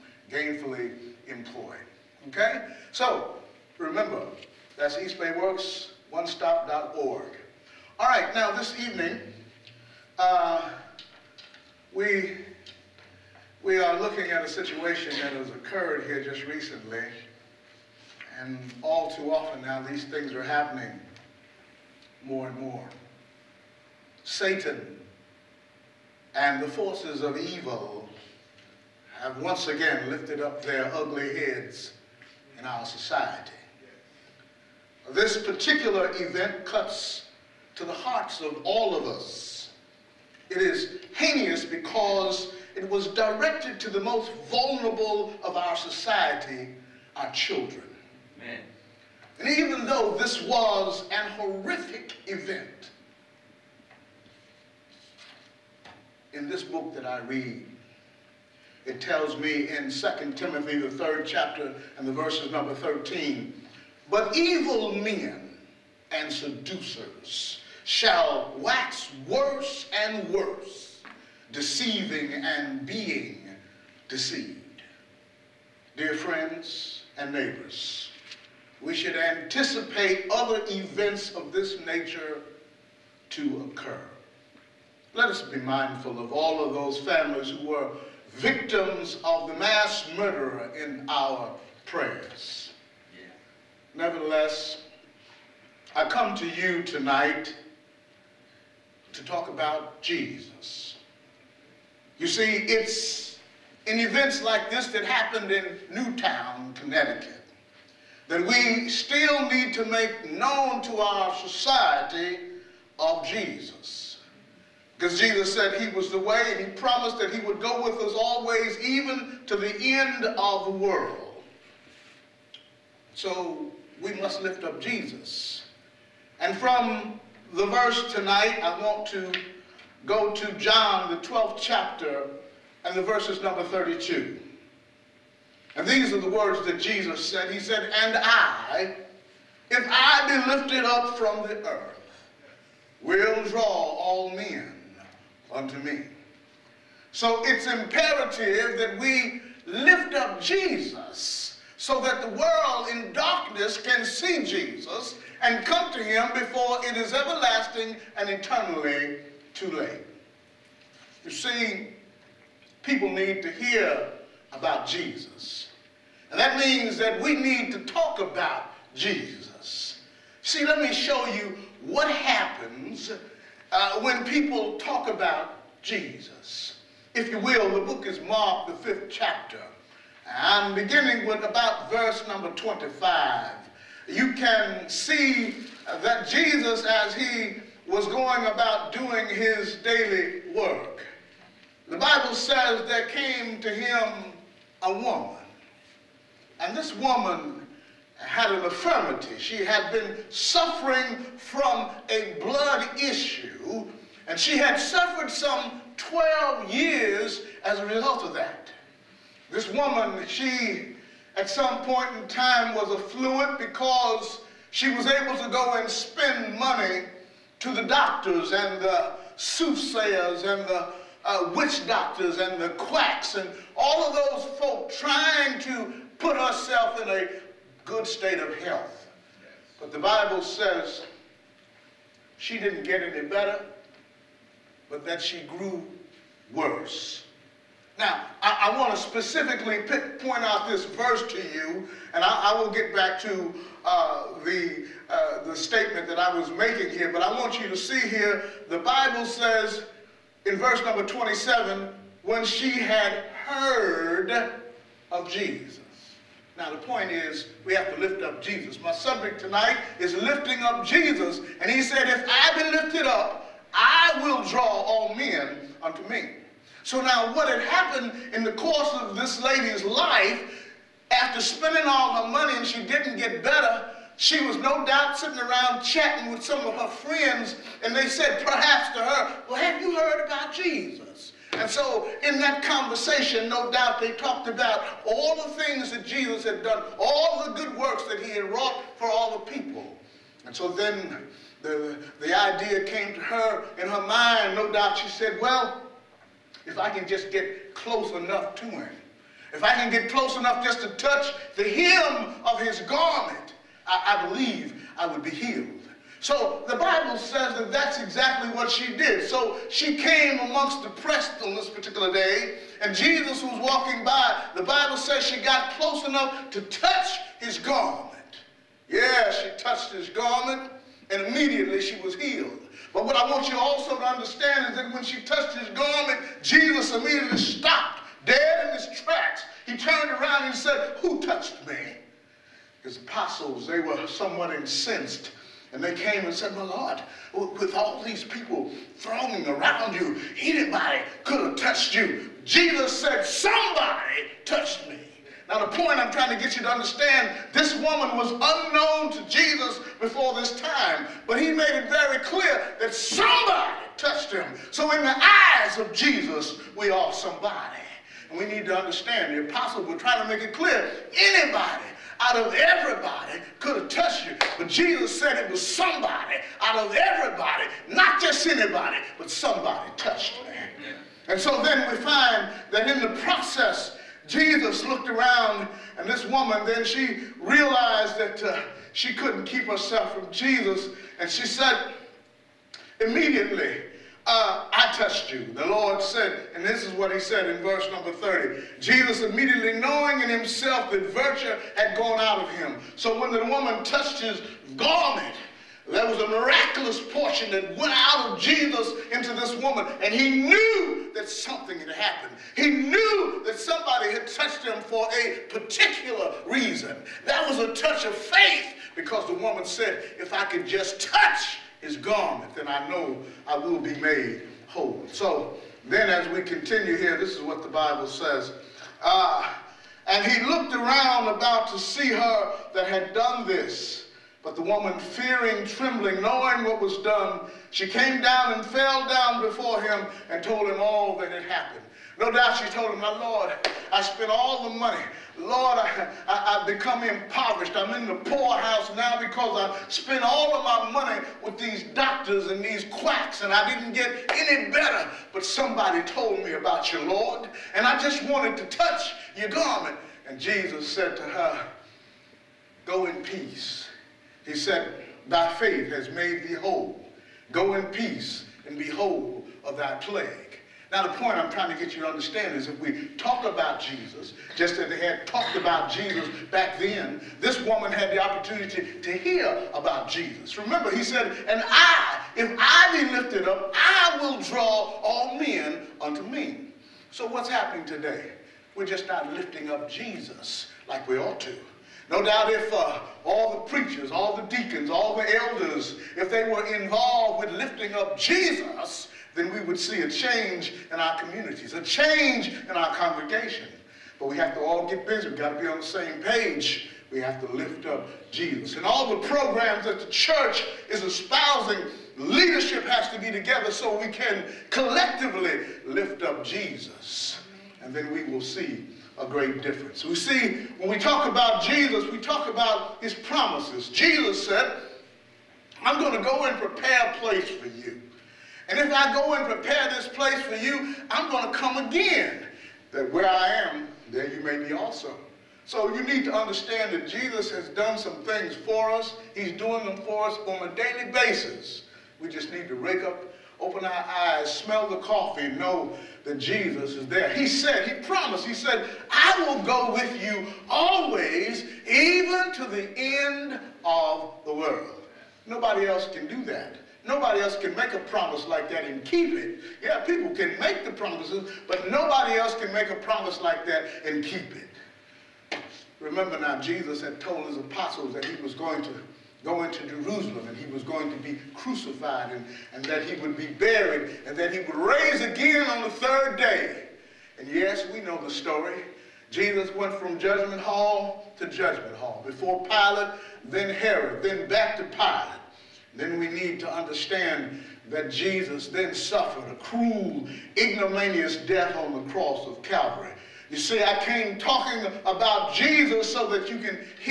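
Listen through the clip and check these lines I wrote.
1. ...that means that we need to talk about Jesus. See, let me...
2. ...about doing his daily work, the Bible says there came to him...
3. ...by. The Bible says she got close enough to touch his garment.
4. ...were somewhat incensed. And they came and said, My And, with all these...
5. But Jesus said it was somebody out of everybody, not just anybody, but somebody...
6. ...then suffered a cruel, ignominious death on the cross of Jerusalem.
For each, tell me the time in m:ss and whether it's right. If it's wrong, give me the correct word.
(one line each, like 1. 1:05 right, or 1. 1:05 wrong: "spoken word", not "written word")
1. 2:46 right
2. 3:08 right
3. 5:14 right
4. 5:33 wrong: "Lord", not "And"
5. 6:04 right
6. 9:38 wrong: "Calvary", not "Jerusalem".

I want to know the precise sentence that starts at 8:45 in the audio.
So you need to understand that Jesus has done some things for us.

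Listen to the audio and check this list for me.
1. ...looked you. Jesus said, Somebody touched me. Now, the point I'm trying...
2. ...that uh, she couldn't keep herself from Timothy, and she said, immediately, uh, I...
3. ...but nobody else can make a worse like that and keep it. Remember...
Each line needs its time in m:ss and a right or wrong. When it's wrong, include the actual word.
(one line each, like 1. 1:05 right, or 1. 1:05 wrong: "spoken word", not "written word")
1. 5:41 wrong: "touched", not "looked"
2. 6:18 wrong: "Jesus", not "Timothy"
3. 9:11 wrong: "promise", not "worse".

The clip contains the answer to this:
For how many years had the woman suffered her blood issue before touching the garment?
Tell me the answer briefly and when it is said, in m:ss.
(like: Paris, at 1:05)
12, at 3:25.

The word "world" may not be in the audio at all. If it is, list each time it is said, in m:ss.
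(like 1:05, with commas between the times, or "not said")
2:00, 2:32, 9:04.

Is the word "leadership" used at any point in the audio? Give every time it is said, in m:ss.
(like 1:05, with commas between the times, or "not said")
8:22.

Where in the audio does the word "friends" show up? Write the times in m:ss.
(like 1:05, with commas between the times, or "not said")
1:16, 4:36.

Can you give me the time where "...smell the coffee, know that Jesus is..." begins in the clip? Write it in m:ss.
8:54.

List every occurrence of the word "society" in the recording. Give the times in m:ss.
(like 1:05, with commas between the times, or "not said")
0:32, 0:45, 1:51.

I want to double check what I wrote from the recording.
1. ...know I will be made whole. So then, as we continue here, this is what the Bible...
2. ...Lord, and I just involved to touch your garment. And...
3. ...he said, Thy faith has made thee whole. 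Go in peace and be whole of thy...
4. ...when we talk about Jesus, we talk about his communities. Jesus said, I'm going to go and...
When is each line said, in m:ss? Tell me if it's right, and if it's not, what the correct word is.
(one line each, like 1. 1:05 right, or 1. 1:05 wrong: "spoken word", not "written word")
1. 6:52 right
2. 7:27 wrong: "wanted", not "involved"
3. 7:34 right
4. 8:30 wrong: "promises", not "communities".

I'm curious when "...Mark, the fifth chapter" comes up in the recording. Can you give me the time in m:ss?
2:58.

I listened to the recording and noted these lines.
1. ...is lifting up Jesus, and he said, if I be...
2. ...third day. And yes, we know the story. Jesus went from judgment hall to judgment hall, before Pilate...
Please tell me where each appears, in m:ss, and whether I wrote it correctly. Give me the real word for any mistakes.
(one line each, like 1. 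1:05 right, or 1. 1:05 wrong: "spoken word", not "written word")
1. 4:19 right
2. 9:25 right.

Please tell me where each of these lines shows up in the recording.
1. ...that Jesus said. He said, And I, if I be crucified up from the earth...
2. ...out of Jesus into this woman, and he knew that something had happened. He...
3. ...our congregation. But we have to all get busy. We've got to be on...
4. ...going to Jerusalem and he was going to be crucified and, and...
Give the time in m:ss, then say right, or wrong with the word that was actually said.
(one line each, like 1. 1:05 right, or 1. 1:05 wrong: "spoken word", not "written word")
1. 2:16 wrong: "lifted", not "crucified"
2. 6:37 right
3. 8:12 right
4. 9:19 right.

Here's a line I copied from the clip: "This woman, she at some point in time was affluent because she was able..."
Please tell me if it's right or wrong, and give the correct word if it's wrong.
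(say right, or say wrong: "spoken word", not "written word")
right.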